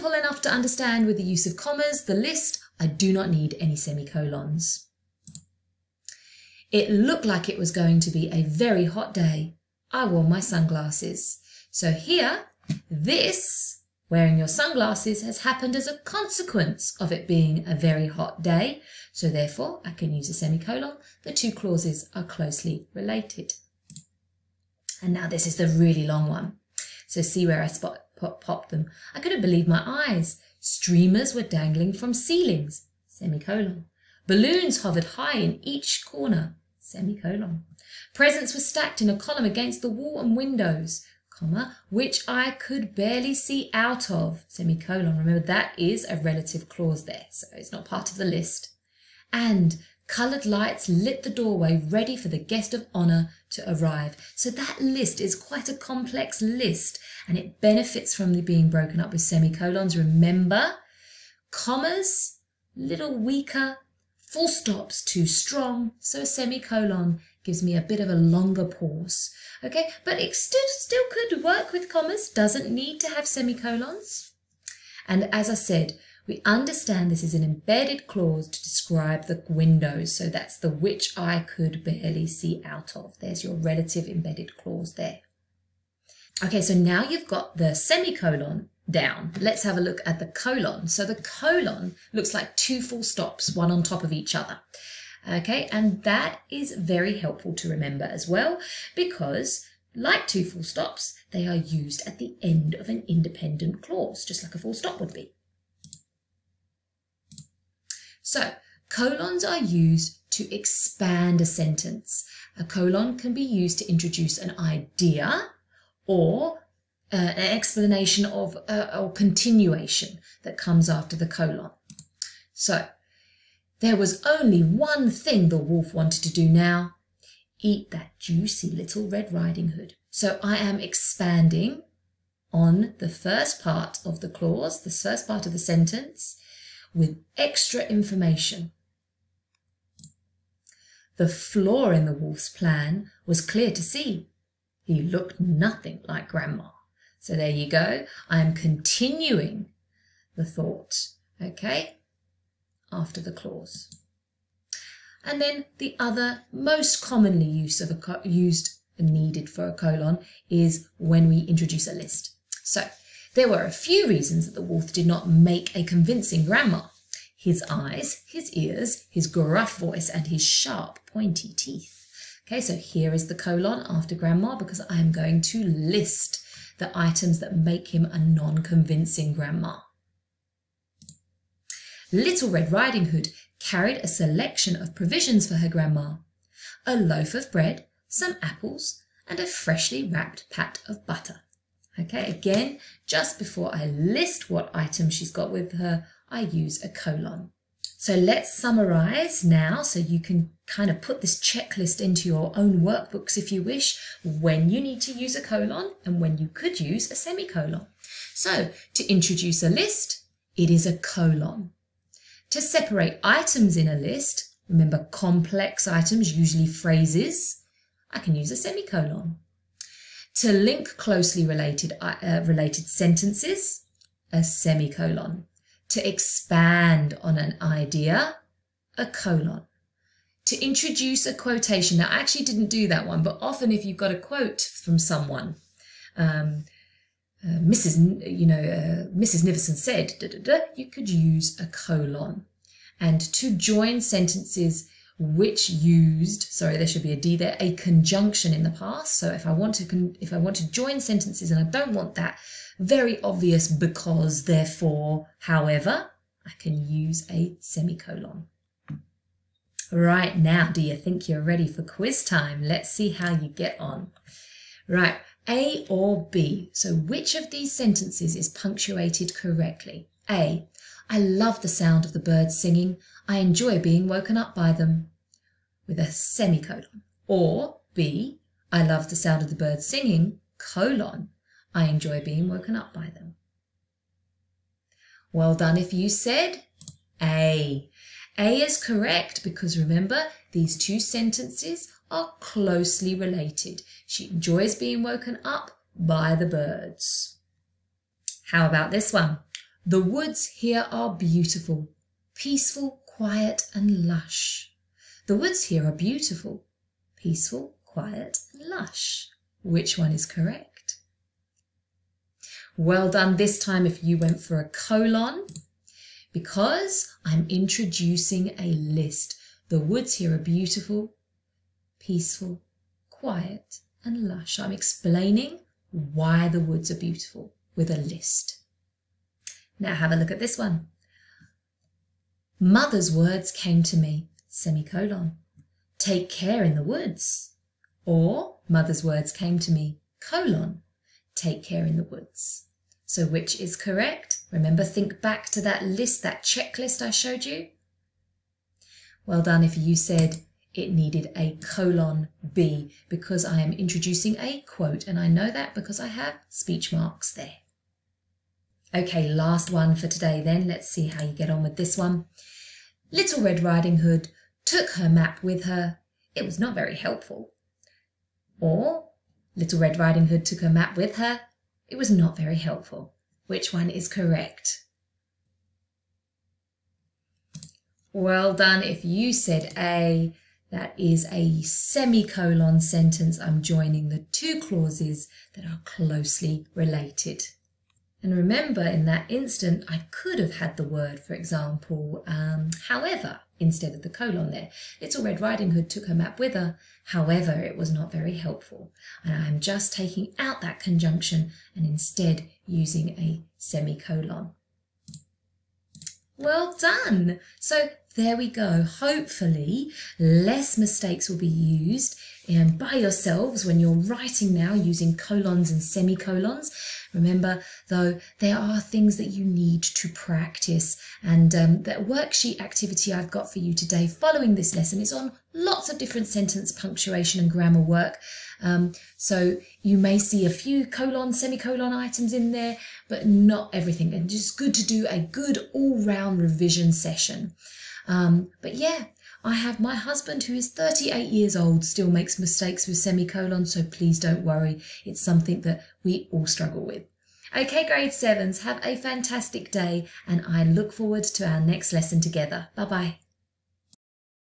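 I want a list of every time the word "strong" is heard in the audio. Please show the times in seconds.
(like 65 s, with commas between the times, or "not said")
65 s.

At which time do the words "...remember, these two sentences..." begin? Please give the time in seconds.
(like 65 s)
289 s.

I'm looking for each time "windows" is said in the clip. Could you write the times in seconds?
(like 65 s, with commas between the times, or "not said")
40 s, 79 s.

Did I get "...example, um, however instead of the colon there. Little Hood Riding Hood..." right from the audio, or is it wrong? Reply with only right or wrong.
wrong.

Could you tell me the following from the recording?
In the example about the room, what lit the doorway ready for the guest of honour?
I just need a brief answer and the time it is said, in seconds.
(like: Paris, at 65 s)
coloured lights, at 50 s.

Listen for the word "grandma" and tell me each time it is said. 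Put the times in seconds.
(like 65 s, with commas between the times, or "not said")
146 s, 166 s, 174 s, 179 s, 185 s.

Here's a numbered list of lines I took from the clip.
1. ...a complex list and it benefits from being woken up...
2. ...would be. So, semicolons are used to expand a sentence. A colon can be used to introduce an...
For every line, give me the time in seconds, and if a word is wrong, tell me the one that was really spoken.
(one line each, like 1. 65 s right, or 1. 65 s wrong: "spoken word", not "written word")
1. 55 s wrong: "broken", not "woken"
2. 104 s wrong: "colons", not "semicolons".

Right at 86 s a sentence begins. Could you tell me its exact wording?
Okay, so now you've got the semicolon down.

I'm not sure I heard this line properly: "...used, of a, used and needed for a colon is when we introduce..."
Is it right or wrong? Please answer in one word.
right.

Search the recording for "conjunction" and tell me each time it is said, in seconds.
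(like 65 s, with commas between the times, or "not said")
247 s, 400 s.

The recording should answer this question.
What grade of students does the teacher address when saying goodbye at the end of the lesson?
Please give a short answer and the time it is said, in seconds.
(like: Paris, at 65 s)
grade 7, at 447 s.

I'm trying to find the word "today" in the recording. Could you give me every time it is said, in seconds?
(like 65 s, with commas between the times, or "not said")
360 s, 423 s.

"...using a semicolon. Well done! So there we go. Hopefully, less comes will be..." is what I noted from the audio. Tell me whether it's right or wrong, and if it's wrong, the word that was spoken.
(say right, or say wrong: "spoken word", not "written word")
wrong: "mistakes", not "comes".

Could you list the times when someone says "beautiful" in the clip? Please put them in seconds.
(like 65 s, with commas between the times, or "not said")
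301 s, 305 s, 320 s, 326 s.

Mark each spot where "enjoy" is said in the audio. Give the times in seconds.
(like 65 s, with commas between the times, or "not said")
273 s, 281 s, 294 s.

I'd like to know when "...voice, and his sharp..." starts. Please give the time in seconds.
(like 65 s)
169 s.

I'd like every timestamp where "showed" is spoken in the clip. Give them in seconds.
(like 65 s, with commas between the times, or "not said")
347 s.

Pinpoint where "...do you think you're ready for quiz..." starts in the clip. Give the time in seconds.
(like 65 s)
260 s.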